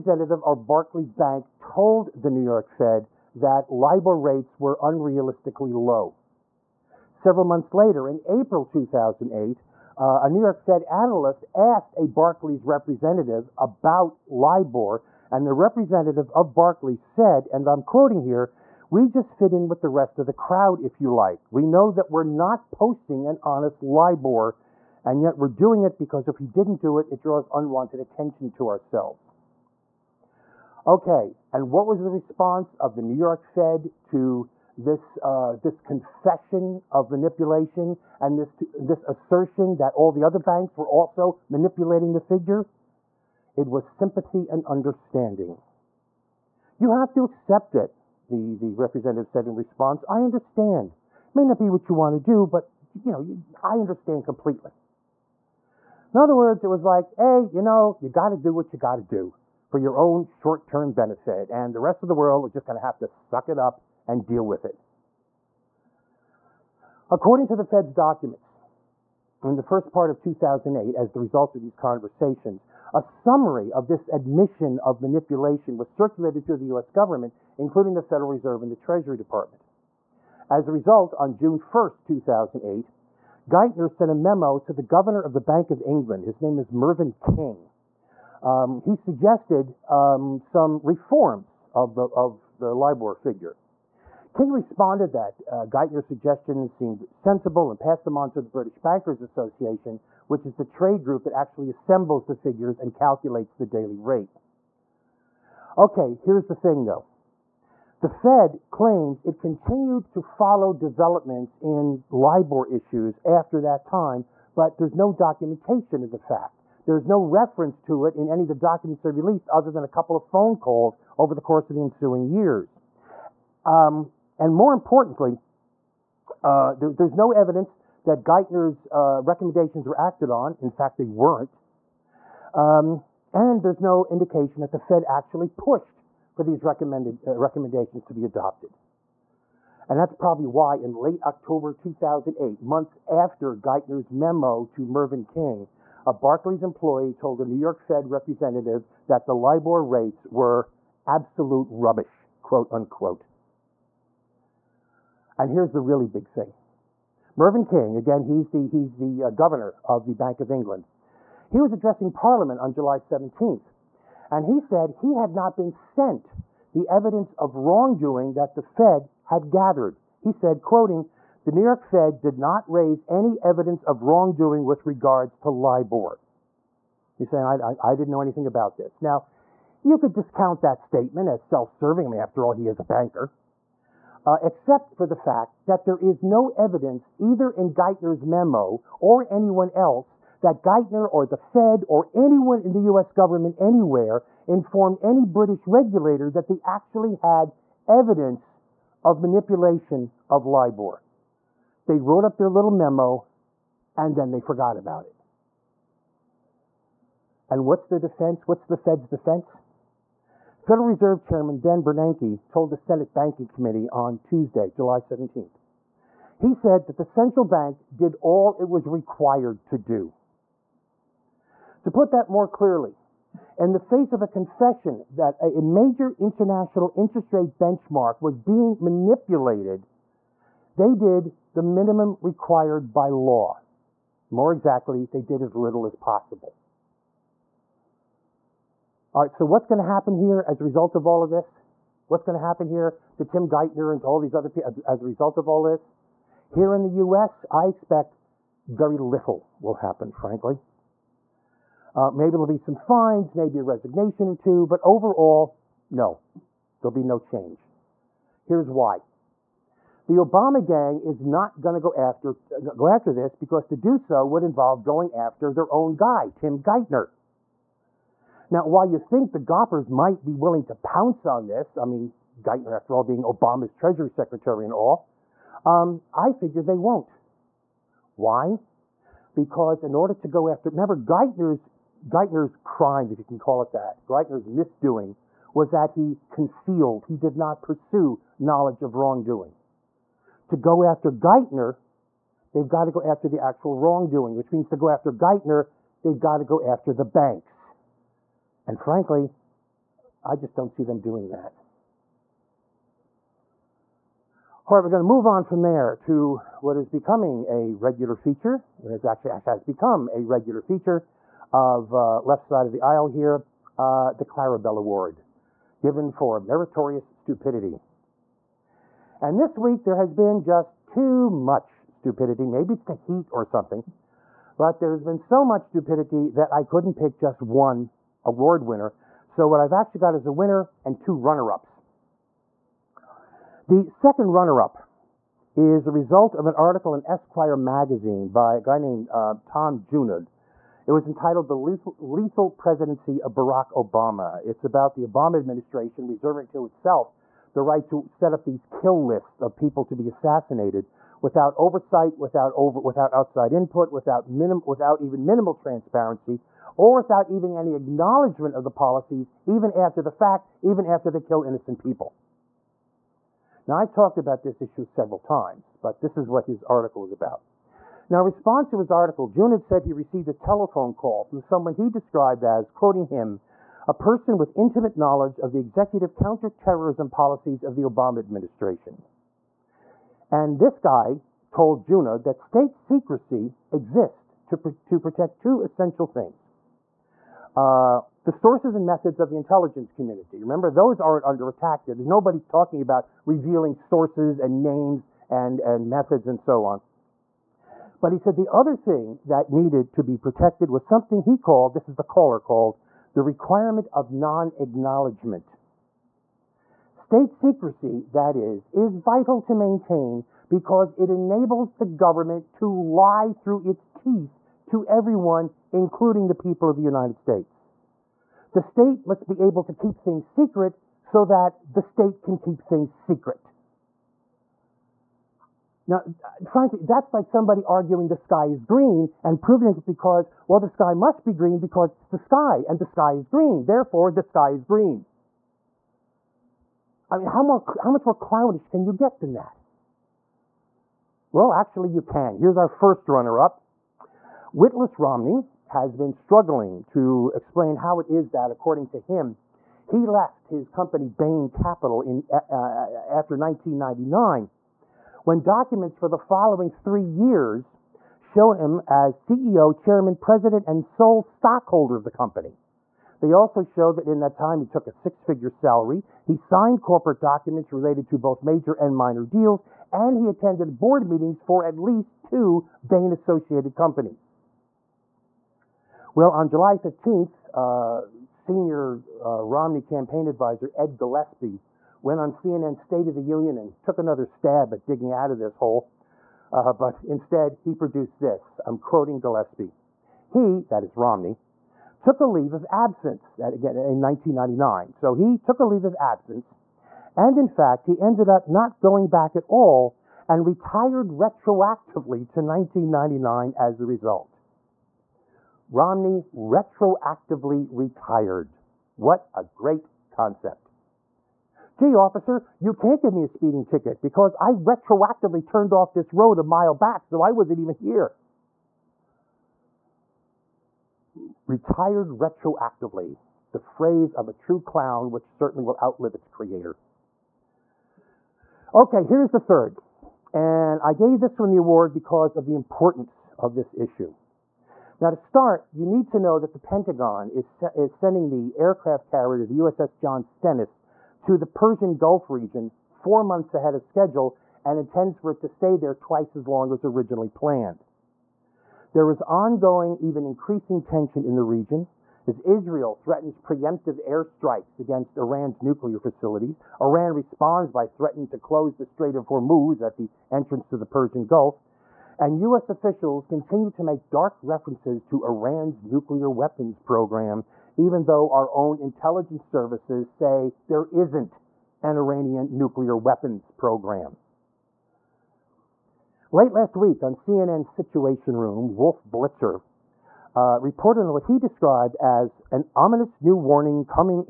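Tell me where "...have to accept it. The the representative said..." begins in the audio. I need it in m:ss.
0:46.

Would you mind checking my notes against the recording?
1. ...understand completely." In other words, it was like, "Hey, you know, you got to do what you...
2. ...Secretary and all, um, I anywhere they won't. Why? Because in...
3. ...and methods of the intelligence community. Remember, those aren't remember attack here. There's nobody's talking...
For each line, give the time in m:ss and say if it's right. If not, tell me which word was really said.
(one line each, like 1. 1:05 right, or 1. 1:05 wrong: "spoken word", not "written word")
1. 0:53 right
2. 4:34 wrong: "figure", not "anywhere"
3. 6:28 wrong: "under", not "remember".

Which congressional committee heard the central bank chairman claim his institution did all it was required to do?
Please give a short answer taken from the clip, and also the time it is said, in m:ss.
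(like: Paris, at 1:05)
Senate Banking Committee, at 3:32.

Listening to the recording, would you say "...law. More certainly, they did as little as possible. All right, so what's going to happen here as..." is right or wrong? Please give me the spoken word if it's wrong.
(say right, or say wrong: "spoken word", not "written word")
wrong: "exactly", not "certainly".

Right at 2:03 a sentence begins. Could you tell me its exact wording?
Um, and more importantly, uh, there, there's no evidence that Geithner's uh, recommendations were acted on.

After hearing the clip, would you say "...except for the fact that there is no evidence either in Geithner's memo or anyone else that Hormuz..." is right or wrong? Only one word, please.
wrong.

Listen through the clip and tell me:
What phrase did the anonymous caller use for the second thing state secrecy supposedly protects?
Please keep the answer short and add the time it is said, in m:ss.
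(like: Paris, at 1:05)
requirement of non-acknowledgement, at 6:43.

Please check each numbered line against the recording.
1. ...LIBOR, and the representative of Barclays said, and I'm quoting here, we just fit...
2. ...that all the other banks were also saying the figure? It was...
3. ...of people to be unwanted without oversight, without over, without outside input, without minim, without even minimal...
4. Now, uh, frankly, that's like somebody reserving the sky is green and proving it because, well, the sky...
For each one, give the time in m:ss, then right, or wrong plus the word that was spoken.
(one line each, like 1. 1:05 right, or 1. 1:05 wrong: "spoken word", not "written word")
1. 0:14 right
2. 0:39 wrong: "manipulating", not "saying"
3. 5:49 wrong: "assassinated", not "unwanted"
4. 7:05 wrong: "arguing", not "reserving".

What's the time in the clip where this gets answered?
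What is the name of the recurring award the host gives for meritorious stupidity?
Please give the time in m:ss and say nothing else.
5:14.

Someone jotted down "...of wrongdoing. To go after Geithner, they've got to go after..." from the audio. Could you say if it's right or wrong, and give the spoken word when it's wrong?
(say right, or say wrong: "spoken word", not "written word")
right.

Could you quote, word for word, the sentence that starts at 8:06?
Uh, but instead, he produced this.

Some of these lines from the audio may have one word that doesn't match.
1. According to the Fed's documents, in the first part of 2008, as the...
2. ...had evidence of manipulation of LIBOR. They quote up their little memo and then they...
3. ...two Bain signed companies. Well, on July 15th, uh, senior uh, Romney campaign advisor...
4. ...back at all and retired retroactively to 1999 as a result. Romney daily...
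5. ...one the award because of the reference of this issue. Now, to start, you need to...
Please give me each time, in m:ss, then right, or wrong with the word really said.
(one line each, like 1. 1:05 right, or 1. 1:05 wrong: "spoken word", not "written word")
1. 1:07 right
2. 3:17 wrong: "wrote", not "quote"
3. 7:52 wrong: "associated", not "signed"
4. 8:19 wrong: "retroactively", not "daily"
5. 8:51 wrong: "importance", not "reference".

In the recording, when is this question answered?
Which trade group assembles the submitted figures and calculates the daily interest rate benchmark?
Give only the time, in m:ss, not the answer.
1:38.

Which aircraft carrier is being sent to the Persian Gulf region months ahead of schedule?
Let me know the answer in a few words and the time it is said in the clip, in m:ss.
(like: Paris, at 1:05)
USS John Stennis, at 8:59.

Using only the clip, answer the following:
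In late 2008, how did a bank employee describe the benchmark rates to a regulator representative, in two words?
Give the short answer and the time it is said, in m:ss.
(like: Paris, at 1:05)
absolute rubbish, at 2:31.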